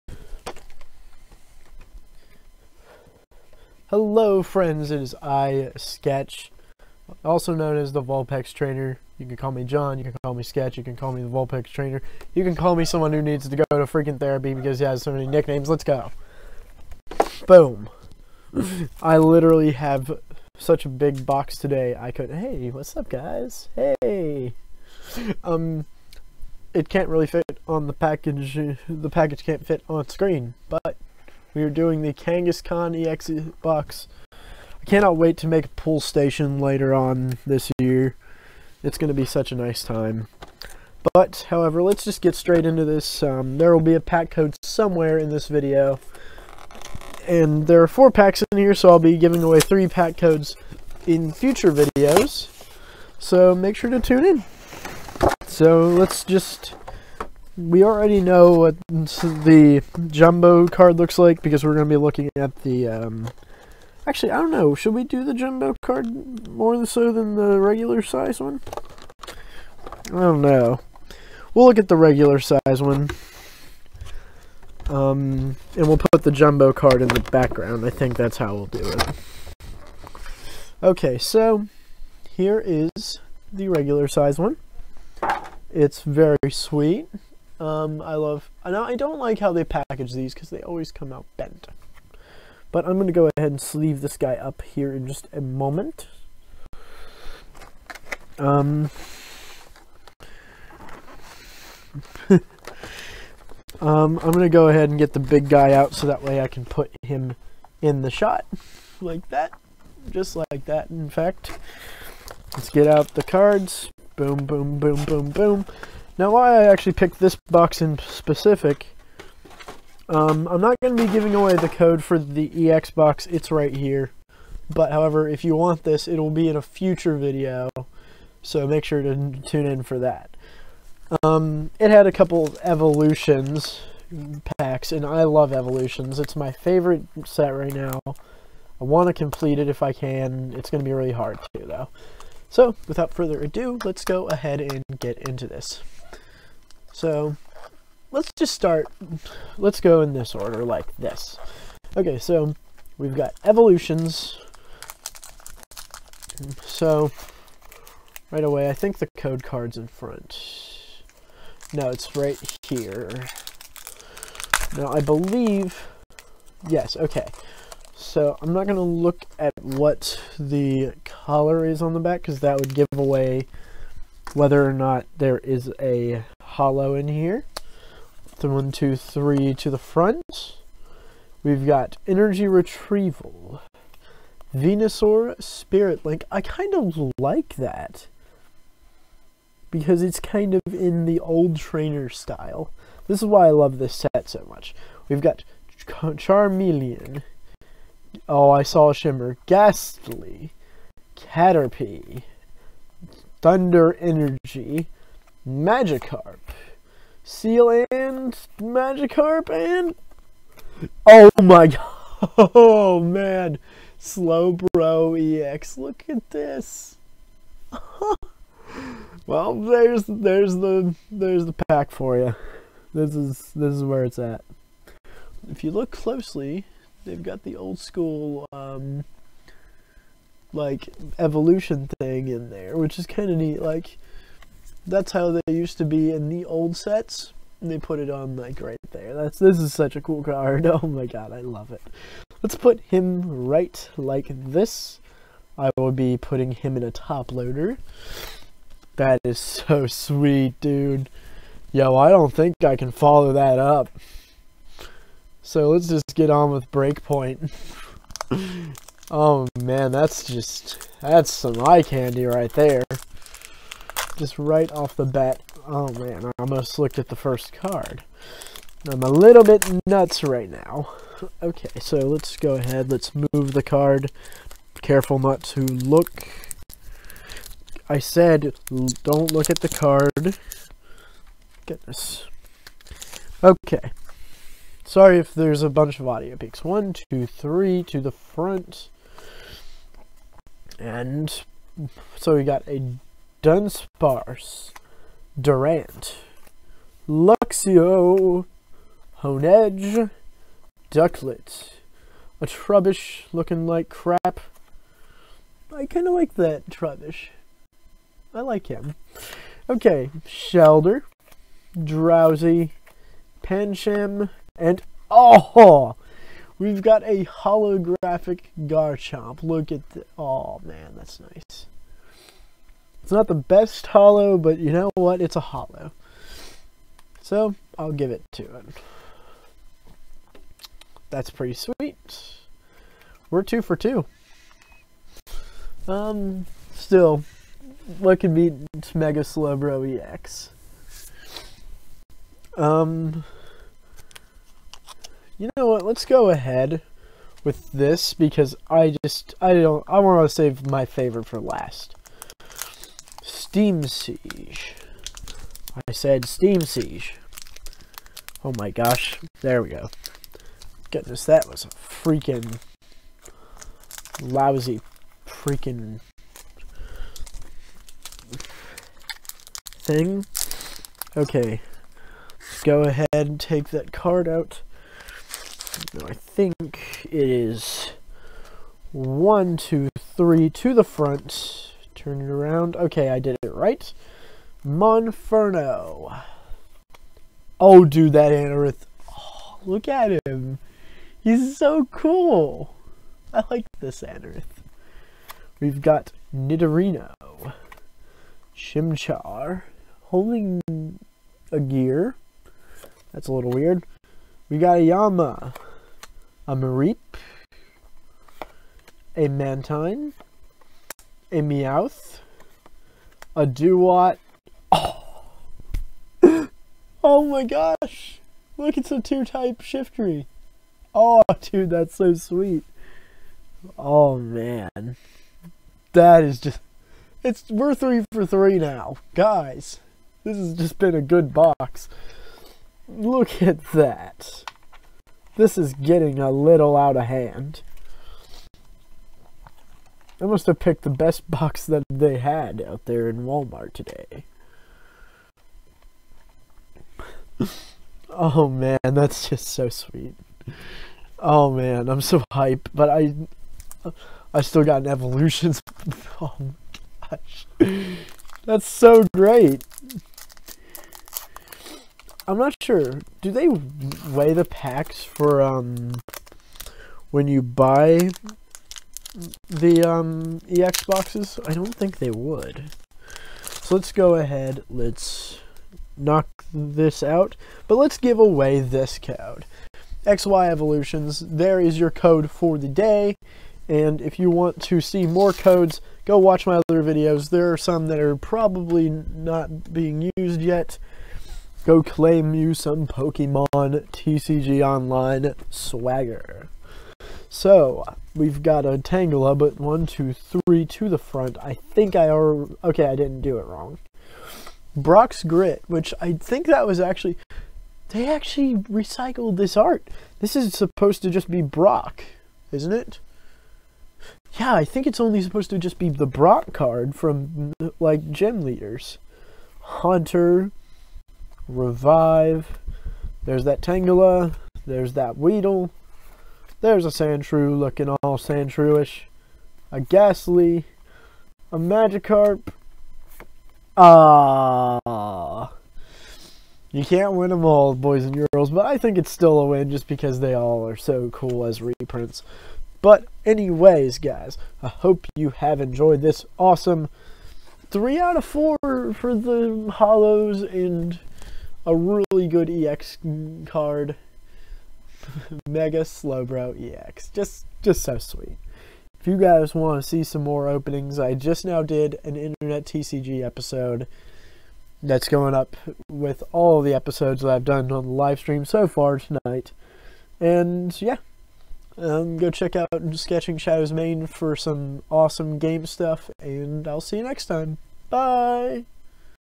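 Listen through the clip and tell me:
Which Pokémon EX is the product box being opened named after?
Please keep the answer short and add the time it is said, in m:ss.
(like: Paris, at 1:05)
Kangaskhan EX box, at 0:32.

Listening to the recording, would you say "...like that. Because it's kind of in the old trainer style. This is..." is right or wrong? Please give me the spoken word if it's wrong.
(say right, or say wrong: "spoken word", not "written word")
right.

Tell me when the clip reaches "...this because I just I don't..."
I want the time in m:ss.
5:47.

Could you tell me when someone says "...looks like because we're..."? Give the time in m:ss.
1:00.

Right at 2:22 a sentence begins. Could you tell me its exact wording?
So, without further ado, let's go ahead and get into this.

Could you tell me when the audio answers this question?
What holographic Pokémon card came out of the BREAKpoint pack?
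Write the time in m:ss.
5:18.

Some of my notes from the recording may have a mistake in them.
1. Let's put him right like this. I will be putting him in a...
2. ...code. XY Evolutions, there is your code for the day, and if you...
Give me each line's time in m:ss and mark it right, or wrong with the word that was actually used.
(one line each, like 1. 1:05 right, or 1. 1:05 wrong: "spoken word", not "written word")
1. 4:02 right
2. 7:58 right.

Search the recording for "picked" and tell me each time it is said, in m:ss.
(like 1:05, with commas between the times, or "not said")
1:56, 7:20.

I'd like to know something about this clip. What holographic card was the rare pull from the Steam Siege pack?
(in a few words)
Shiftry.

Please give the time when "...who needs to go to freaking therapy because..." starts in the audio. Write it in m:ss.
0:13.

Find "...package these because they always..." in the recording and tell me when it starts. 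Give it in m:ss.
1:29.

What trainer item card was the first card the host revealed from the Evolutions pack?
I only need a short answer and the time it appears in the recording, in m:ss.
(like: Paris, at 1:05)
Energy Retrieval, at 3:02.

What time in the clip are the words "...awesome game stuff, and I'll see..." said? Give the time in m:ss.
9:34.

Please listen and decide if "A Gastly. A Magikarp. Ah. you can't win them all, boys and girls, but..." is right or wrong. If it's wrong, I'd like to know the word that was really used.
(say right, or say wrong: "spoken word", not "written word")
right.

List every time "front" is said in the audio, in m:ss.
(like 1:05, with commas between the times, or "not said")
2:39, 2:59, 4:48, 6:20, 8:20.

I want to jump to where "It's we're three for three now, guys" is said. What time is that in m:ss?
7:07.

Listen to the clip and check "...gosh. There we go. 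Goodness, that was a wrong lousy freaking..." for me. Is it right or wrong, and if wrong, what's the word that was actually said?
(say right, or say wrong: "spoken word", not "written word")
wrong: "freaking", not "wrong".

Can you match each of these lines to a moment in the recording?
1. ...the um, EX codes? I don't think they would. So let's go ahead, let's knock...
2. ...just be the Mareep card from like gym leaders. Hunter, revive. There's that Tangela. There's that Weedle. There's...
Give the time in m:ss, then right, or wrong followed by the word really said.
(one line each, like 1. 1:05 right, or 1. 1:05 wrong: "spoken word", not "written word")
1. 7:49 wrong: "boxes", not "codes"
2. 8:35 wrong: "Brock", not "Mareep".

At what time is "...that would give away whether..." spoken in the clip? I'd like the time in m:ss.
2:52.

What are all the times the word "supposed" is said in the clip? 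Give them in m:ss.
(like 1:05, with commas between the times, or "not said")
8:30, 8:35.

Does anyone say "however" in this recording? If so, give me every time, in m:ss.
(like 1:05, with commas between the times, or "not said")
0:41, 2:04.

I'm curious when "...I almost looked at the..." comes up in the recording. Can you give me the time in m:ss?
4:26.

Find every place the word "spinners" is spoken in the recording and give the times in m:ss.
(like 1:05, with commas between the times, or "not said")
not said.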